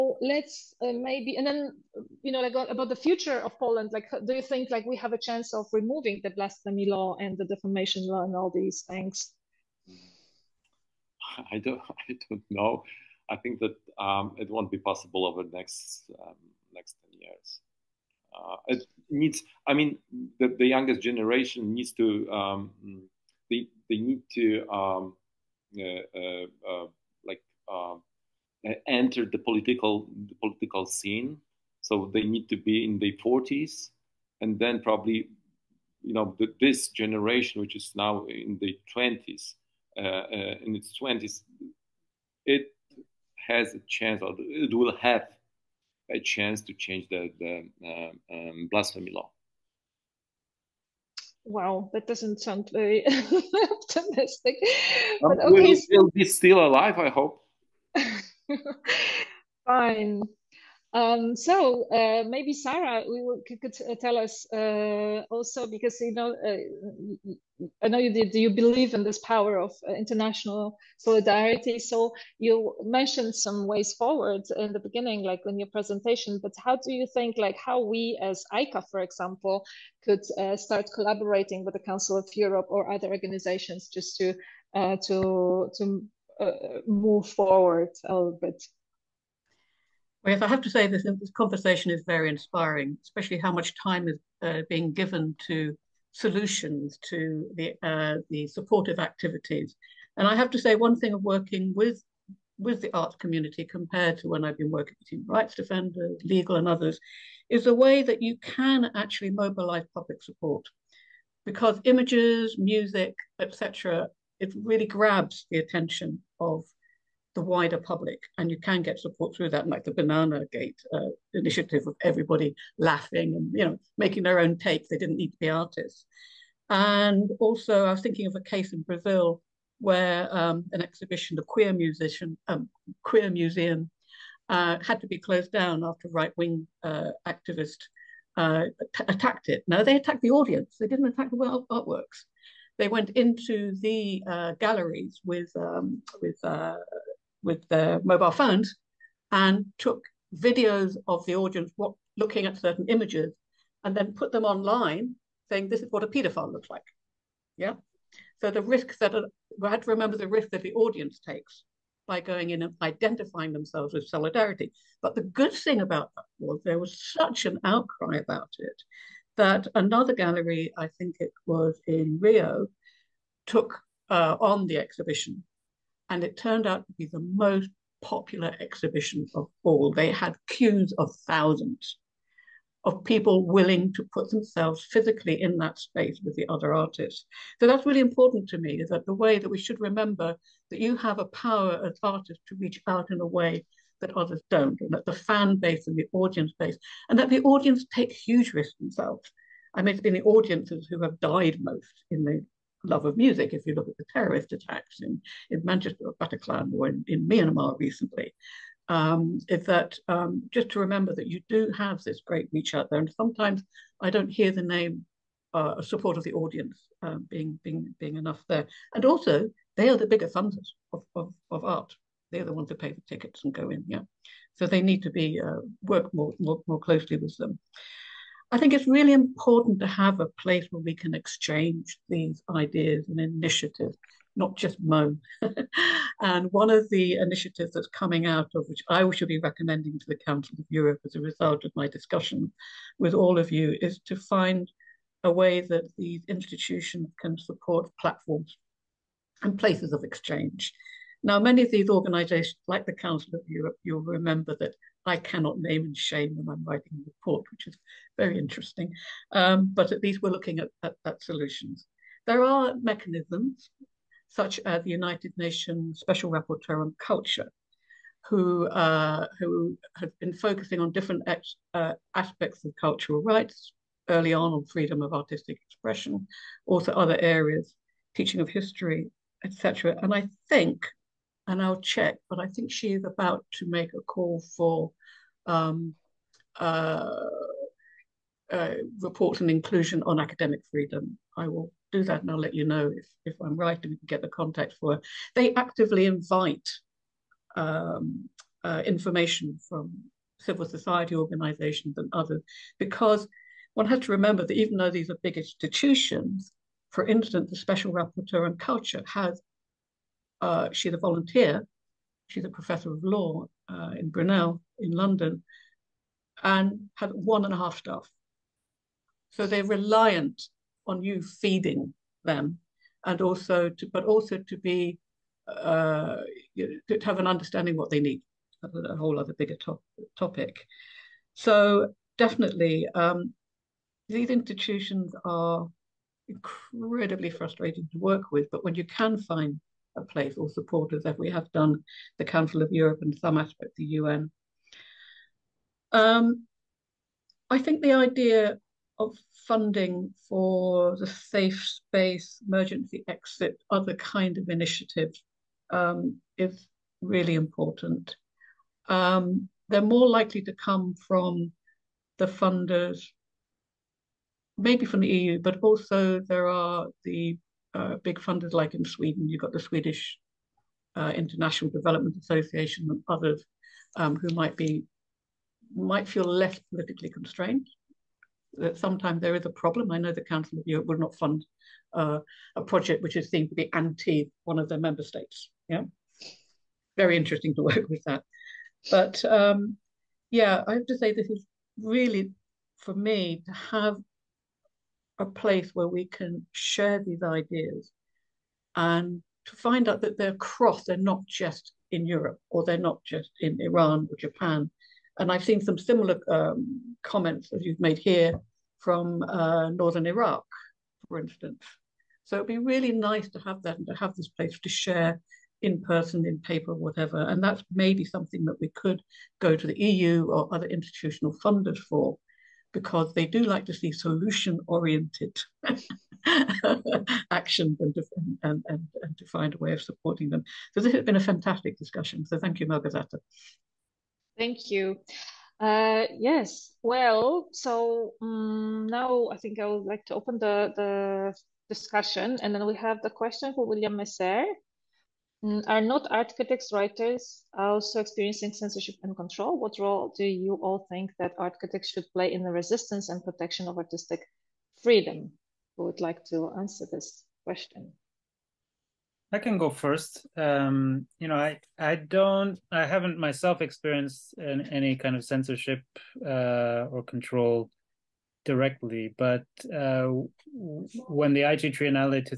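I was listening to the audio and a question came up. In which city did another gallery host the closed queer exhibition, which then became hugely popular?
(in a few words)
Rio.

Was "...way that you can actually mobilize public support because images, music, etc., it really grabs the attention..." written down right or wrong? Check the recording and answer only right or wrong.
right.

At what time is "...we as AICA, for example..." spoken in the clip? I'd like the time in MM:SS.
01:17.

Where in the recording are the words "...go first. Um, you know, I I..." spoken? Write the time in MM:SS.
07:39.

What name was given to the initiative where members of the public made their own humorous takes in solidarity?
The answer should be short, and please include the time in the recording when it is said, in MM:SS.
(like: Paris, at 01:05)
Banana Gate, at 01:59.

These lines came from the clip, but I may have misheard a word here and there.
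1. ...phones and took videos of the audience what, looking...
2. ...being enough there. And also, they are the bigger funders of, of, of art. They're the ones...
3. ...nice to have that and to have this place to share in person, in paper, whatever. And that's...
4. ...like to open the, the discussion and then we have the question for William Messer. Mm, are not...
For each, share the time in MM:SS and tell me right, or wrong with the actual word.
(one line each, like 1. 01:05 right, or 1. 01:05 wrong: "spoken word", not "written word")
1. 02:28 right
2. 03:37 right
3. 06:52 right
4. 07:19 right.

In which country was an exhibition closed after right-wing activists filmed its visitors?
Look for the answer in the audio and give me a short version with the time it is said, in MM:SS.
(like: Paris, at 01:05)
Brazil, at 02:08.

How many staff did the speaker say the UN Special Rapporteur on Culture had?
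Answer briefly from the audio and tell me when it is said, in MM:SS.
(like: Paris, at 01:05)
1.5, at 05:17.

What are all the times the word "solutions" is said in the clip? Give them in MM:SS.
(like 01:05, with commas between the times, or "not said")
01:36, 04:21, 07:03.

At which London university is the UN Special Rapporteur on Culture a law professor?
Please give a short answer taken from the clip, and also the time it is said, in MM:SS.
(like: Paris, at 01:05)
Brunel, at 05:14.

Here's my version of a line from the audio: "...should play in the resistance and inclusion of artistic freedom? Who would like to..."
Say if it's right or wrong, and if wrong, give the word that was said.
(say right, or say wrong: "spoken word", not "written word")
wrong: "protection", not "inclusion".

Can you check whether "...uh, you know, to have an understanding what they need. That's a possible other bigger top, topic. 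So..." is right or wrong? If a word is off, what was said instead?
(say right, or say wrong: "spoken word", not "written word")
wrong: "whole", not "possible".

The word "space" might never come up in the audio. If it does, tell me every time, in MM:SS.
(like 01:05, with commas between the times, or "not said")
03:05, 05:51.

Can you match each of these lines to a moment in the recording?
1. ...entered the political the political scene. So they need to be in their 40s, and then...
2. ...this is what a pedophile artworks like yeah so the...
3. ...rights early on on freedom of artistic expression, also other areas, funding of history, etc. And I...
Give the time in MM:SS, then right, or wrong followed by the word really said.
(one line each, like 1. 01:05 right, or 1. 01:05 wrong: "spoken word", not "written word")
1. 00:28 right
2. 02:35 wrong: "looks", not "artworks"
3. 04:33 wrong: "teaching", not "funding".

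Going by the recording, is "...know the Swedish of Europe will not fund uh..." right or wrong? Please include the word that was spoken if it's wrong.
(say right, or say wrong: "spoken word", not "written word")
wrong: "Council", not "Swedish".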